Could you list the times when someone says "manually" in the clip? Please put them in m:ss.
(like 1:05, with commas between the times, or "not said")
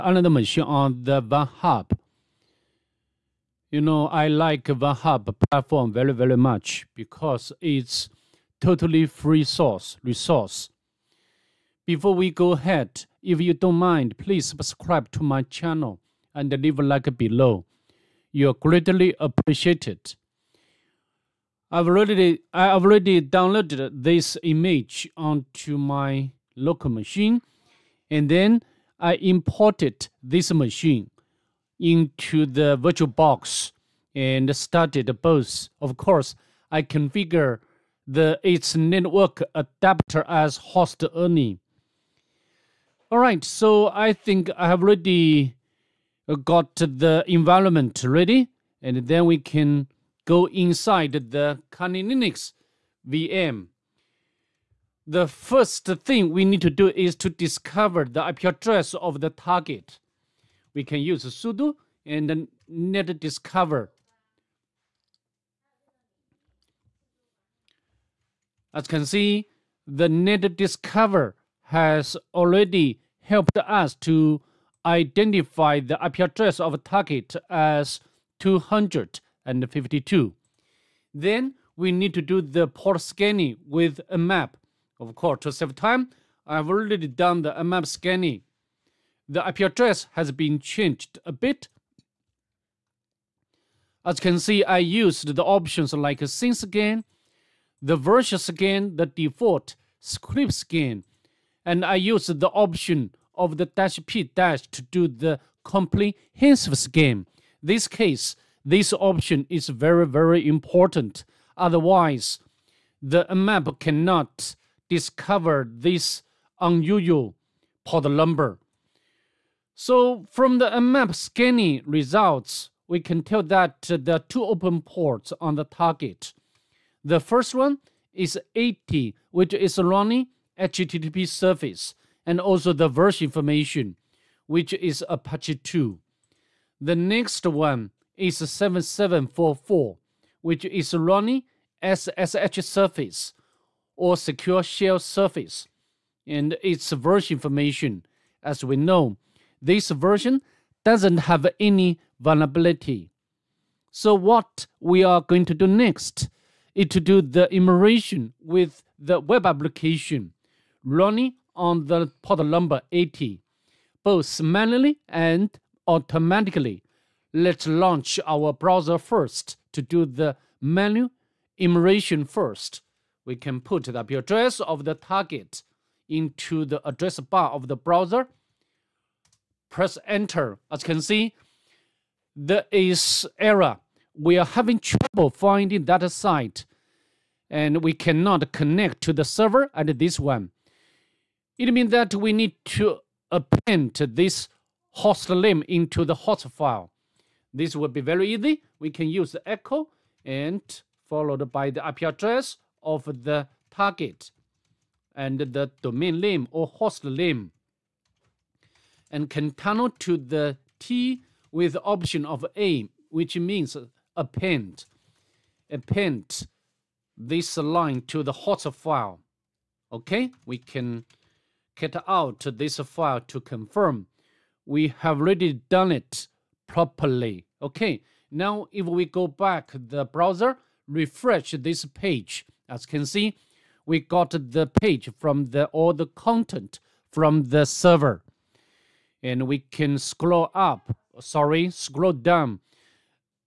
2:44.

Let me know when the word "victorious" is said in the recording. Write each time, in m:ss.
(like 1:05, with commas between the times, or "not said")
not said.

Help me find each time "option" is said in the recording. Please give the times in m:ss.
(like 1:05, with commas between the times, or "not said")
1:35, 1:42, 1:48, 3:31.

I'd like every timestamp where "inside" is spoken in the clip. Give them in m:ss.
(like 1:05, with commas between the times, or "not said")
0:50.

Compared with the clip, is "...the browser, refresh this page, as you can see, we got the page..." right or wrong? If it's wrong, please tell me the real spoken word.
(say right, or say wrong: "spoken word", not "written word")
right.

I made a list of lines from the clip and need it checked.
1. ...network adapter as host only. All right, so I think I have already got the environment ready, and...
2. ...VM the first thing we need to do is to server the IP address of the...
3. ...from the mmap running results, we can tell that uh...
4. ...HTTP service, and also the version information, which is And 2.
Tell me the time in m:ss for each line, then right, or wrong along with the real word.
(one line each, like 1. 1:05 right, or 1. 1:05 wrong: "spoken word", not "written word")
1. 0:38 right
2. 0:53 wrong: "discover", not "server"
3. 2:00 wrong: "scanning", not "running"
4. 2:10 wrong: "Apache", not "And".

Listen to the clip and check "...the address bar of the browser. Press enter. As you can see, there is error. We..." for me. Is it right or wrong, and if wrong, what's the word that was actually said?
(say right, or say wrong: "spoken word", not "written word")
right.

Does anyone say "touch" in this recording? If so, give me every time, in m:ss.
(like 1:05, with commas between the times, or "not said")
not said.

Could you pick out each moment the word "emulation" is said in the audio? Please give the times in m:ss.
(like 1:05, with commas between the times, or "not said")
2:37, 2:51.